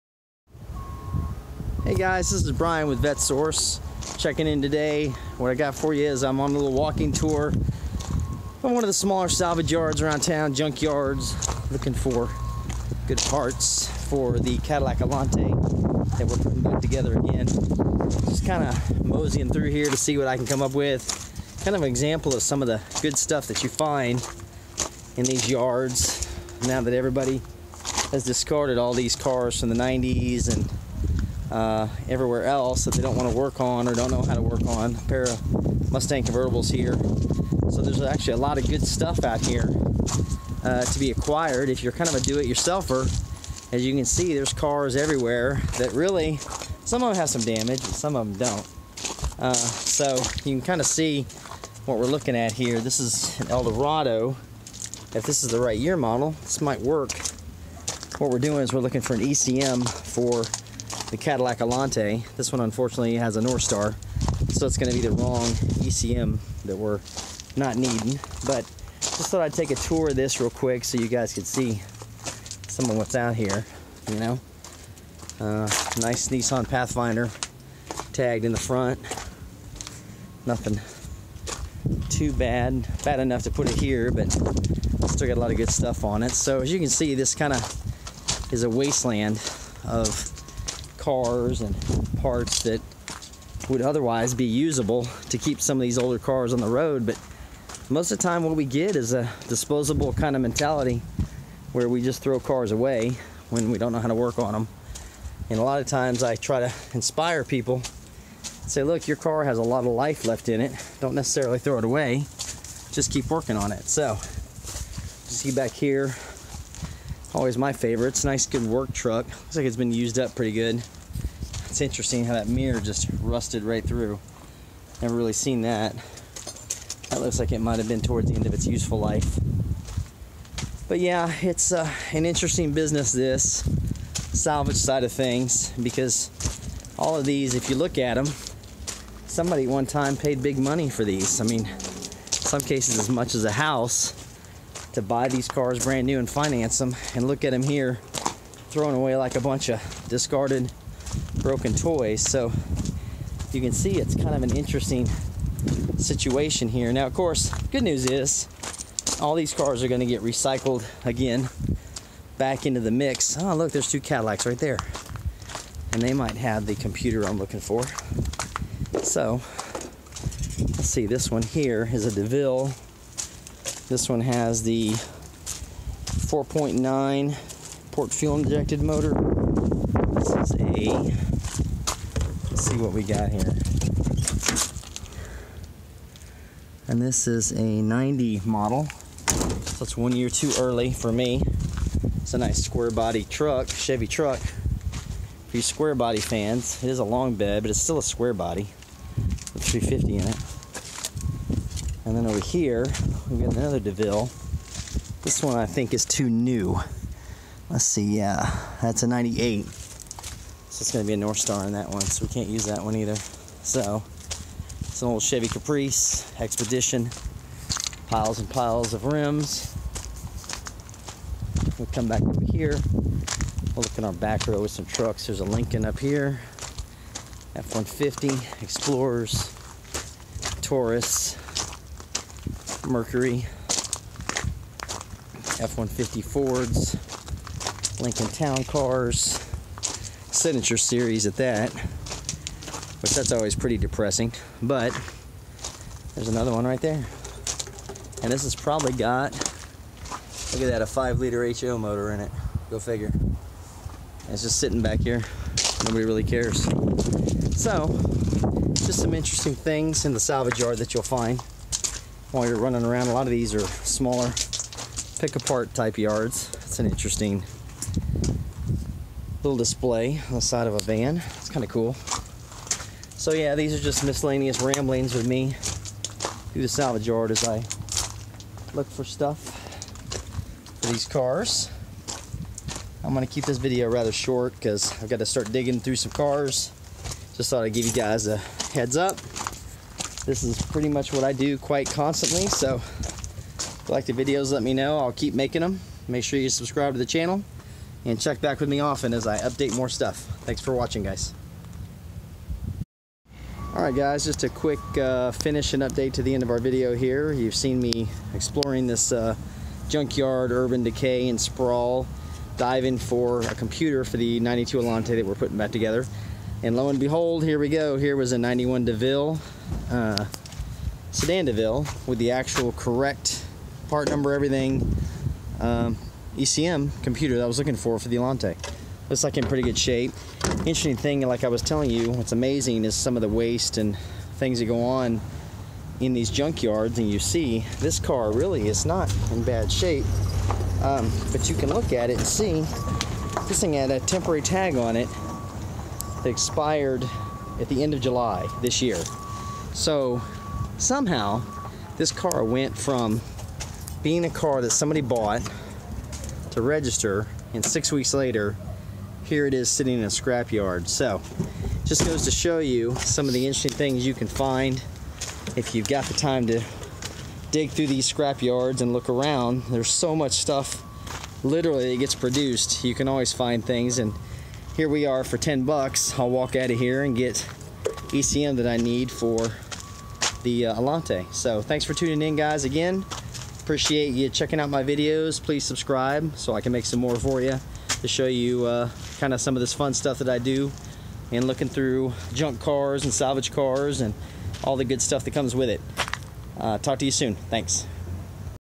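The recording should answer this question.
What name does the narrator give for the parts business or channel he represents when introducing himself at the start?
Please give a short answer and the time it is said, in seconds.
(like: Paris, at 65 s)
VetteSource, at 3 s.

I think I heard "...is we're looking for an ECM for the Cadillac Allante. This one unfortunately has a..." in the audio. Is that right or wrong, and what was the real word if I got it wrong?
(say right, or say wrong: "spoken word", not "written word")
right.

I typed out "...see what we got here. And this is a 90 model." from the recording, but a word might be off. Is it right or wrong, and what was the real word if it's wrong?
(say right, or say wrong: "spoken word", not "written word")
right.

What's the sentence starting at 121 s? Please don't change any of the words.
It's interesting how that mirror just rusted right through.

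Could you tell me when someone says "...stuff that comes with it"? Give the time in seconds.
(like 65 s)
395 s.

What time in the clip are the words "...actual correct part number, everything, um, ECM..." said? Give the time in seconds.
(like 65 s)
322 s.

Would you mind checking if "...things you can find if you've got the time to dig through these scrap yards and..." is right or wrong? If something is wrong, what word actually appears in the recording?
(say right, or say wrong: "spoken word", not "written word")
right.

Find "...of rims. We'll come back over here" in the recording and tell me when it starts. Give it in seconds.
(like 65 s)
218 s.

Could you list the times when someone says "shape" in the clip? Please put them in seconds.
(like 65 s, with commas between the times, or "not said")
329 s, 339 s.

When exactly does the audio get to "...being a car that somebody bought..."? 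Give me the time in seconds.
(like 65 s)
354 s.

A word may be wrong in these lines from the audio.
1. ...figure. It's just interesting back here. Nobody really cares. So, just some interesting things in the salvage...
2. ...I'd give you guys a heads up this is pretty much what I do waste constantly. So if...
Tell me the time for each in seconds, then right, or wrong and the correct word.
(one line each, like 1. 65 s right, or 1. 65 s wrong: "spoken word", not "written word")
1. 252 s wrong: "sitting", not "interesting"
2. 287 s wrong: "quite", not "waste".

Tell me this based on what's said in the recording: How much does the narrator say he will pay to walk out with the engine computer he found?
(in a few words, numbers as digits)
$10.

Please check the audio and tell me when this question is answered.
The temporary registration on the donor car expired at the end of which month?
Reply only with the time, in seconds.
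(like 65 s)
348 s.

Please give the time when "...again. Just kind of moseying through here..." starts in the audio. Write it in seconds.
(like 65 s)
17 s.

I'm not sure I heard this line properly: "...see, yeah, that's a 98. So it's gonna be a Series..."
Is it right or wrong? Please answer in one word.
wrong.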